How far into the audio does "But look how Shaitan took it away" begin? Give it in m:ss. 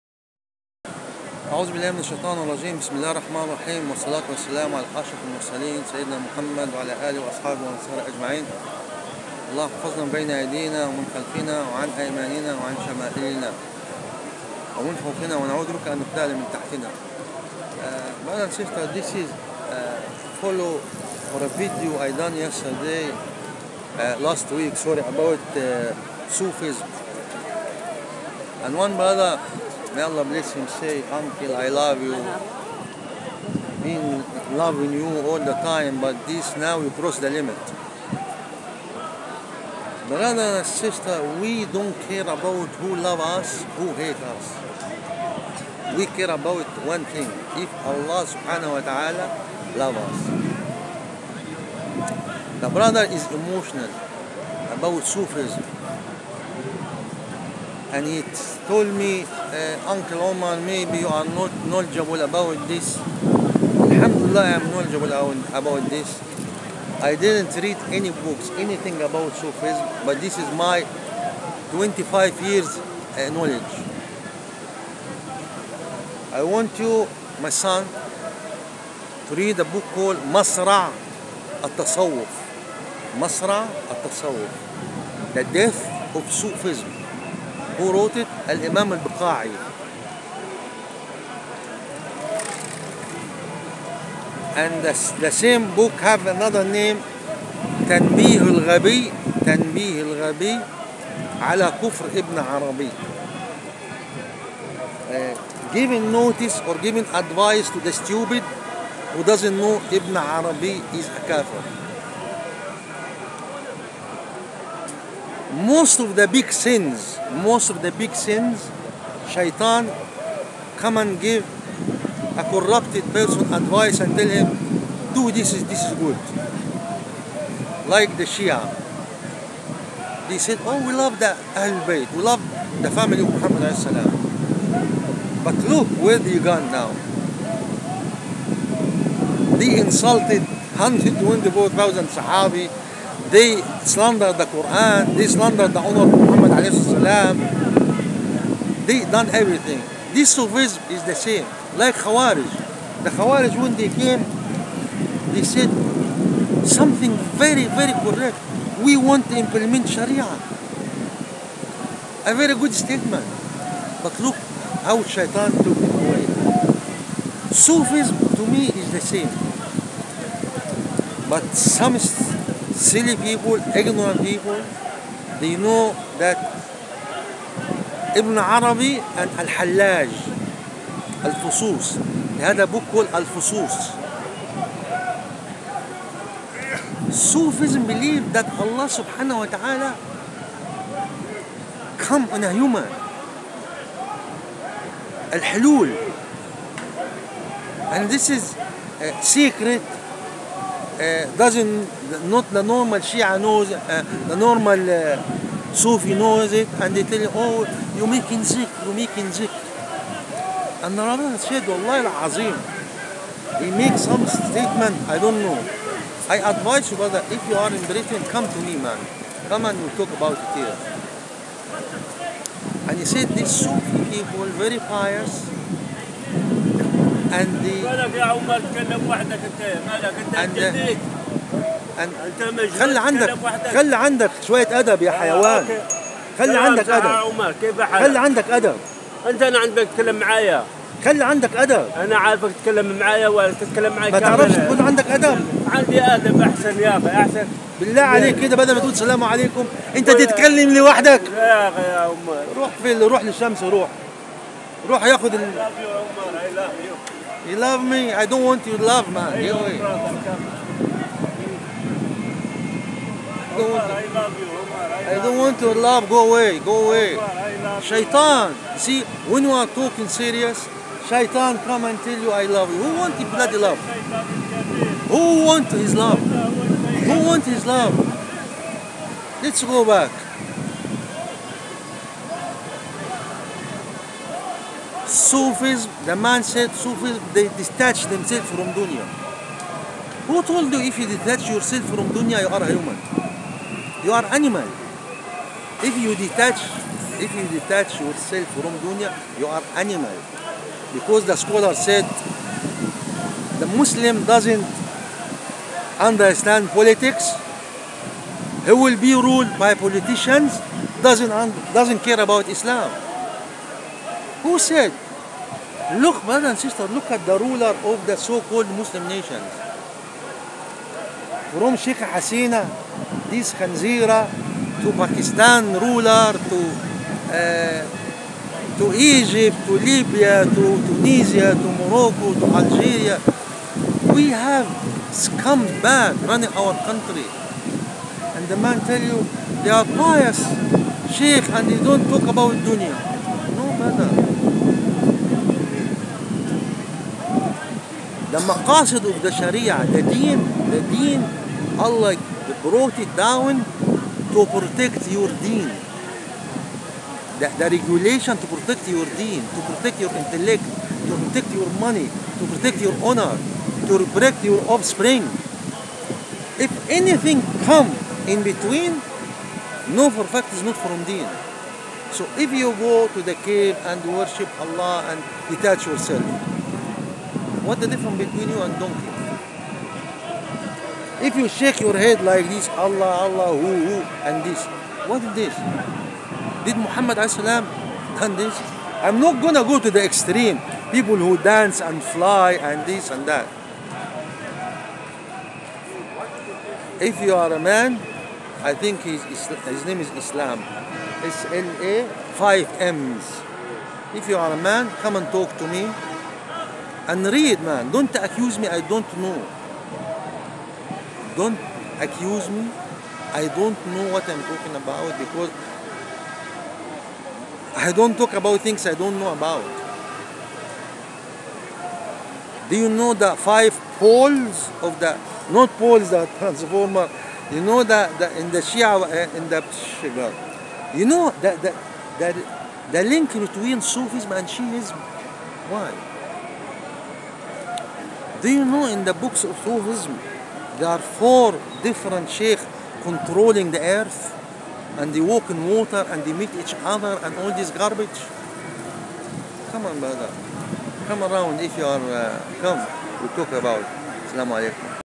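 2:44.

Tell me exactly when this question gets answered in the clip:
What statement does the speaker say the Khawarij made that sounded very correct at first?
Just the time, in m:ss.
2:38.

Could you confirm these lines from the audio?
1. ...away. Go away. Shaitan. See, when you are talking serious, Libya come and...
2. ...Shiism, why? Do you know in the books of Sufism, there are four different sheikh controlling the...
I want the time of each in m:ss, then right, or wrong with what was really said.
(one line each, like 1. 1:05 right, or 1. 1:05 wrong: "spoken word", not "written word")
1. 4:26 wrong: "Shaitan", not "Libya"
2. 7:14 right.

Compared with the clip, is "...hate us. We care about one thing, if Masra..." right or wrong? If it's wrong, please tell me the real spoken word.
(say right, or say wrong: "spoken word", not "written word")
wrong: "Allah", not "Masra".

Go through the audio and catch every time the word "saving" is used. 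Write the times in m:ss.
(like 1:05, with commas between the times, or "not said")
not said.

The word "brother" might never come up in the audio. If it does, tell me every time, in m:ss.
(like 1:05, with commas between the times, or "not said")
0:28, 0:40, 0:52, 3:36, 5:16, 7:29.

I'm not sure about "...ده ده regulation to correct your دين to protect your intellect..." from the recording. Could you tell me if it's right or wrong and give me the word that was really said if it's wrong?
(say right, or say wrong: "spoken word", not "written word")
wrong: "protect", not "correct".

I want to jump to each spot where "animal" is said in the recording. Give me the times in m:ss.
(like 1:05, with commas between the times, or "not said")
4:54, 4:59.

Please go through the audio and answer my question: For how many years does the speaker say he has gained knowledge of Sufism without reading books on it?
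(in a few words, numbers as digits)
25.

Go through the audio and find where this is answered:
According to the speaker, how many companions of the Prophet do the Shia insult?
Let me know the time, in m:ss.
2:20.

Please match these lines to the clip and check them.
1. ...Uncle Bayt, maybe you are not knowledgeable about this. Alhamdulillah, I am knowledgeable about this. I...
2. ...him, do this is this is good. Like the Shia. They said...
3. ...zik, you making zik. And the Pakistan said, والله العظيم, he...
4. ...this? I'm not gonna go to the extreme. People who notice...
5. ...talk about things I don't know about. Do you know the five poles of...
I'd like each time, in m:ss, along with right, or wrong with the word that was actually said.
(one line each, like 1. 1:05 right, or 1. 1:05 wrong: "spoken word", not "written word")
1. 0:59 wrong: "Omar", not "Bayt"
2. 2:04 right
3. 3:28 wrong: "Rabbi", not "Pakistan"
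4. 6:28 wrong: "dance", not "notice"
5. 6:58 right.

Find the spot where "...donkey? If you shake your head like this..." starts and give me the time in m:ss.
6:18.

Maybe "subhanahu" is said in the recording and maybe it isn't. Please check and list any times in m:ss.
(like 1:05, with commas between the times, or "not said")
0:48, 3:08.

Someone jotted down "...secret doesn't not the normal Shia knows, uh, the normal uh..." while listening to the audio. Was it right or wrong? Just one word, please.
right.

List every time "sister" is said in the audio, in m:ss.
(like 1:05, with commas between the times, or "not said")
0:18, 0:40, 5:16.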